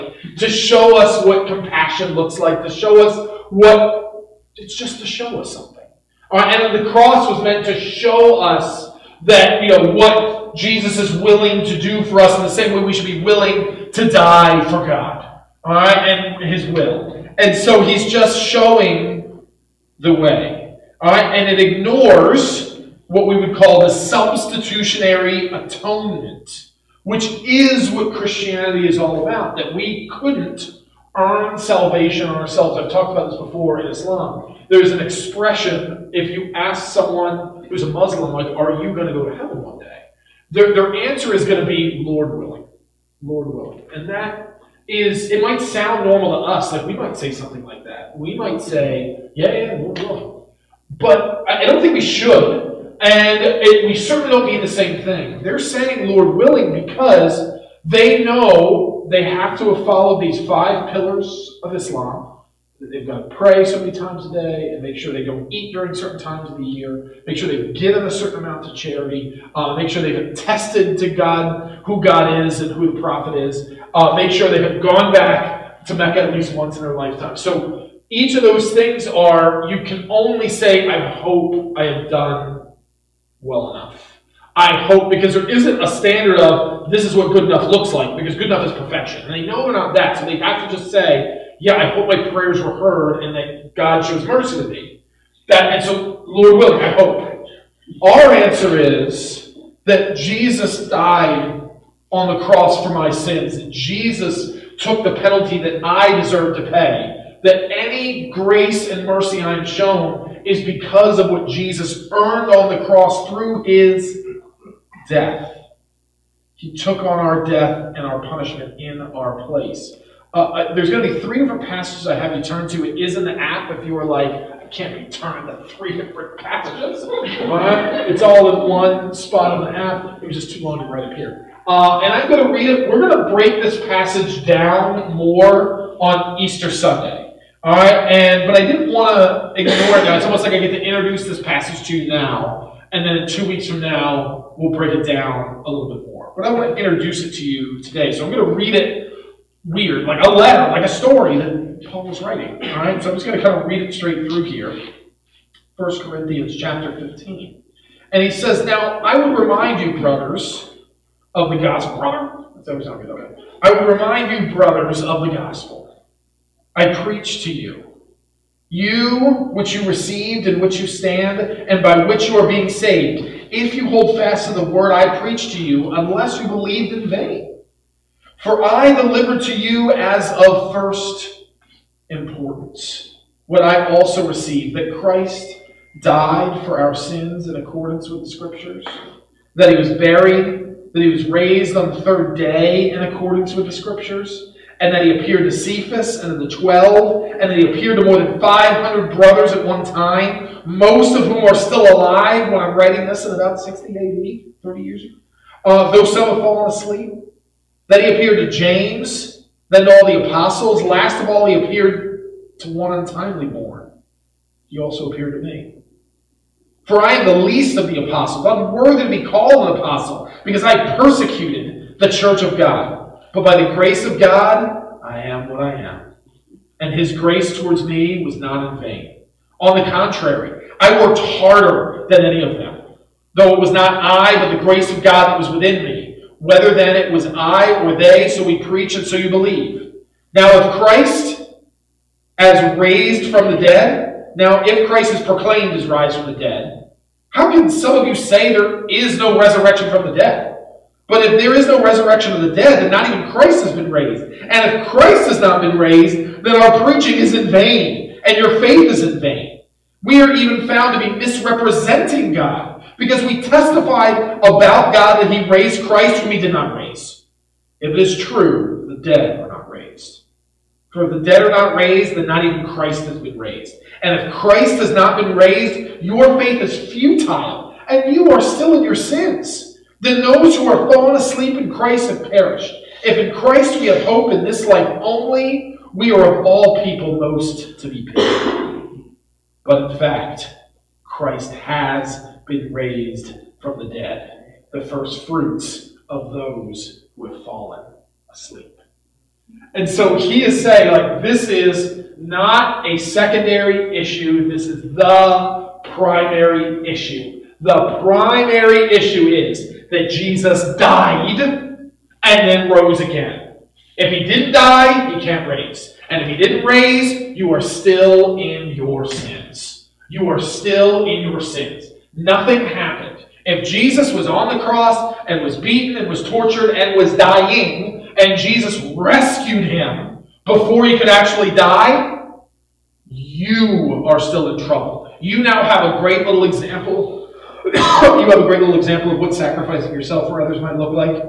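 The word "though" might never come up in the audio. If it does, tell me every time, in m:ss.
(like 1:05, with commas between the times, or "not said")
3:25, 3:53.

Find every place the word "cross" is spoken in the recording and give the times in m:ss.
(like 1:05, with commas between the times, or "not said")
0:06, 1:42, 1:52, 5:24.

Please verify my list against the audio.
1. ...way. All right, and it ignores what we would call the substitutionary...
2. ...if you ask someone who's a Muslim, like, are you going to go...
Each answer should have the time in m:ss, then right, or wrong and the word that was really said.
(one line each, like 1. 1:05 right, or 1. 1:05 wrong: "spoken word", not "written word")
1. 0:20 right
2. 0:36 right.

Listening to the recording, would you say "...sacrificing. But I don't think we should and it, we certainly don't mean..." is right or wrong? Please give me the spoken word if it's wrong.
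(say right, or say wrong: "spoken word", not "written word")
wrong: "willing", not "sacrificing".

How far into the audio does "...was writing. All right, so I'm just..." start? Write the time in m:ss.
2:32.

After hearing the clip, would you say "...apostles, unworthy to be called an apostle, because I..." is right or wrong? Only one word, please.
right.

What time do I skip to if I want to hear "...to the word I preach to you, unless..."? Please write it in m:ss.
2:54.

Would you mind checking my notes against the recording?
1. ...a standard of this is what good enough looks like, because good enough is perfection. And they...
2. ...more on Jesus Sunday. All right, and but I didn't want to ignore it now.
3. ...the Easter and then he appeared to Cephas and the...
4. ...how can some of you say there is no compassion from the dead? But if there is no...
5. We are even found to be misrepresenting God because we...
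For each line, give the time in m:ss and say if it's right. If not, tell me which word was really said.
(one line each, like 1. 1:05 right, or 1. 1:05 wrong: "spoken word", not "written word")
1. 1:25 right
2. 2:15 wrong: "Easter", not "Jesus"
3. 3:13 wrong: "Scriptures", not "Easter"
4. 4:07 wrong: "resurrection", not "compassion"
5. 4:20 right.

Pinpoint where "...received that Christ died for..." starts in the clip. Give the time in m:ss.
3:04.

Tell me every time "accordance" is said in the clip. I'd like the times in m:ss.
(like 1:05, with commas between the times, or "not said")
3:07, 3:13.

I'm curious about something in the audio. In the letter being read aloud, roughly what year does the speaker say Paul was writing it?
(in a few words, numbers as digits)
60 AD.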